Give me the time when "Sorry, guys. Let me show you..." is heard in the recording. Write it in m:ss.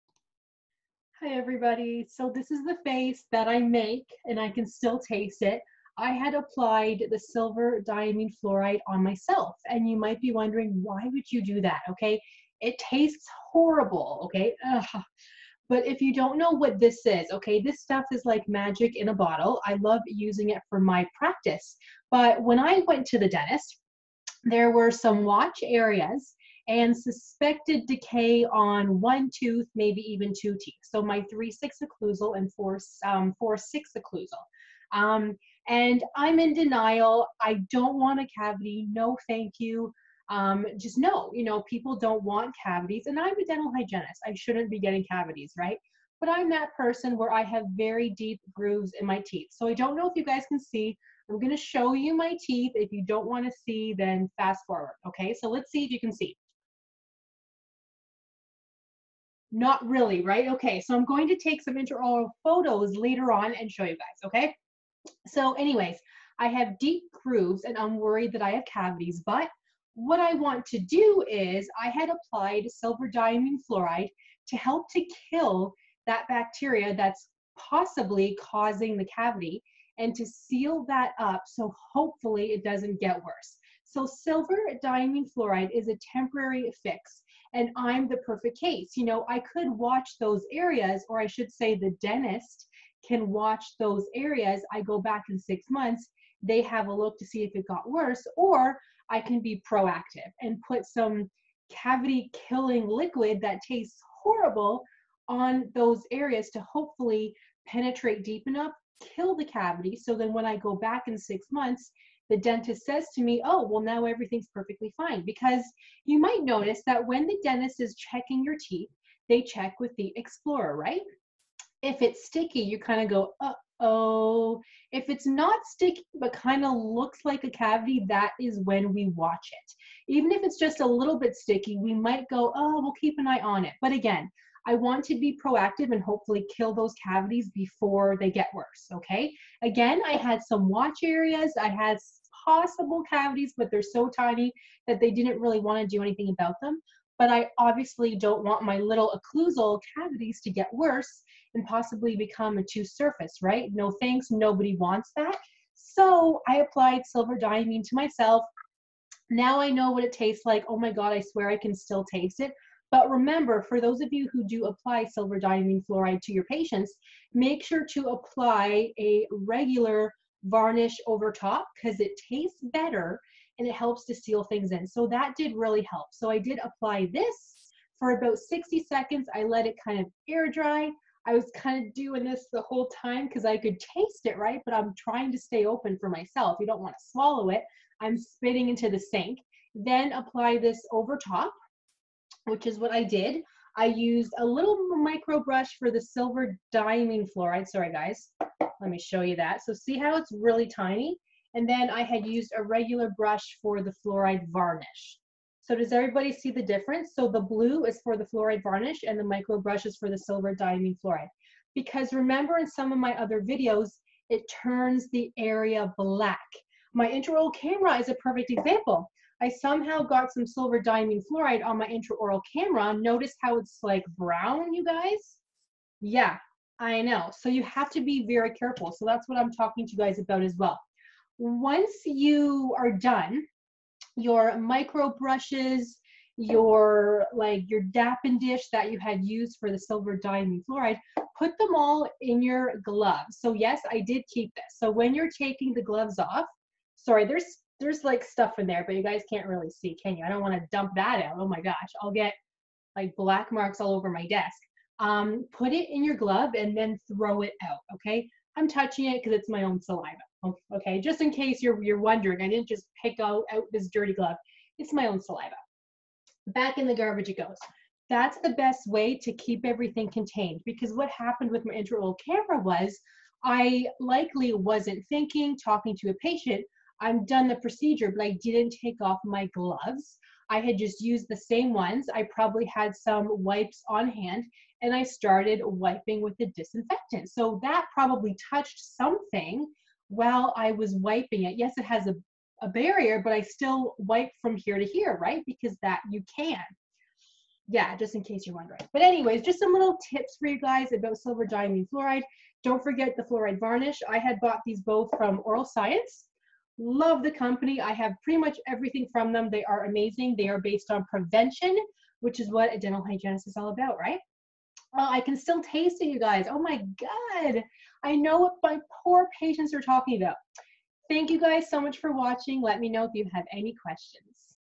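3:17.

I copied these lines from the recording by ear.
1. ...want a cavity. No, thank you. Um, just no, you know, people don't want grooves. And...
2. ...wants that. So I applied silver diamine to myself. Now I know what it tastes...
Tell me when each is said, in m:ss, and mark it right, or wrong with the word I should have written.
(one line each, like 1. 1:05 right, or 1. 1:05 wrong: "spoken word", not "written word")
1. 0:37 wrong: "cavities", not "grooves"
2. 2:34 right.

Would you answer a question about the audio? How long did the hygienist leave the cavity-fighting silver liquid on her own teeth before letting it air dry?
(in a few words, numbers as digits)
60 seconds.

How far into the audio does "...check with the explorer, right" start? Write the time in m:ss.
1:59.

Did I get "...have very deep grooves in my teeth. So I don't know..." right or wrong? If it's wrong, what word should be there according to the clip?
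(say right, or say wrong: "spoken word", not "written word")
right.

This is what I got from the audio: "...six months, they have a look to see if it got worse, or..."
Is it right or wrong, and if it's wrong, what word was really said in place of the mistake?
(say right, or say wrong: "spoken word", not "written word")
right.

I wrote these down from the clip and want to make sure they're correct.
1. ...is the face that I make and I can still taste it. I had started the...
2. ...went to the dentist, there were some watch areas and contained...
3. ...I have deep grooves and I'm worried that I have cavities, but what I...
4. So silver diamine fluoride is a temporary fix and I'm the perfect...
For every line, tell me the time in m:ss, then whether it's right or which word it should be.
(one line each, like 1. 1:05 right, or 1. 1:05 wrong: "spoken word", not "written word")
1. 0:02 wrong: "applied", not "started"
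2. 0:22 wrong: "suspected", not "contained"
3. 1:06 right
4. 1:23 right.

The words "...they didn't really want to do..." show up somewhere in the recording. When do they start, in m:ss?
2:24.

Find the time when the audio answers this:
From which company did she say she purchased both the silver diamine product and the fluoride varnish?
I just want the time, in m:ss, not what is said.
5:05.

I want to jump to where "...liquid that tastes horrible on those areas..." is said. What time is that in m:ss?
1:42.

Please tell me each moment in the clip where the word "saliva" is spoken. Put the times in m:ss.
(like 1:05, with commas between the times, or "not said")
4:19, 4:25.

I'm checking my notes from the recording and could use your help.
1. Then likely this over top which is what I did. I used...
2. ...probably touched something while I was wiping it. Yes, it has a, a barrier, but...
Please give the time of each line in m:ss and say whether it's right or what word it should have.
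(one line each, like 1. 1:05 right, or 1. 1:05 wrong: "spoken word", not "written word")
1. 3:09 wrong: "apply", not "likely"
2. 4:47 right.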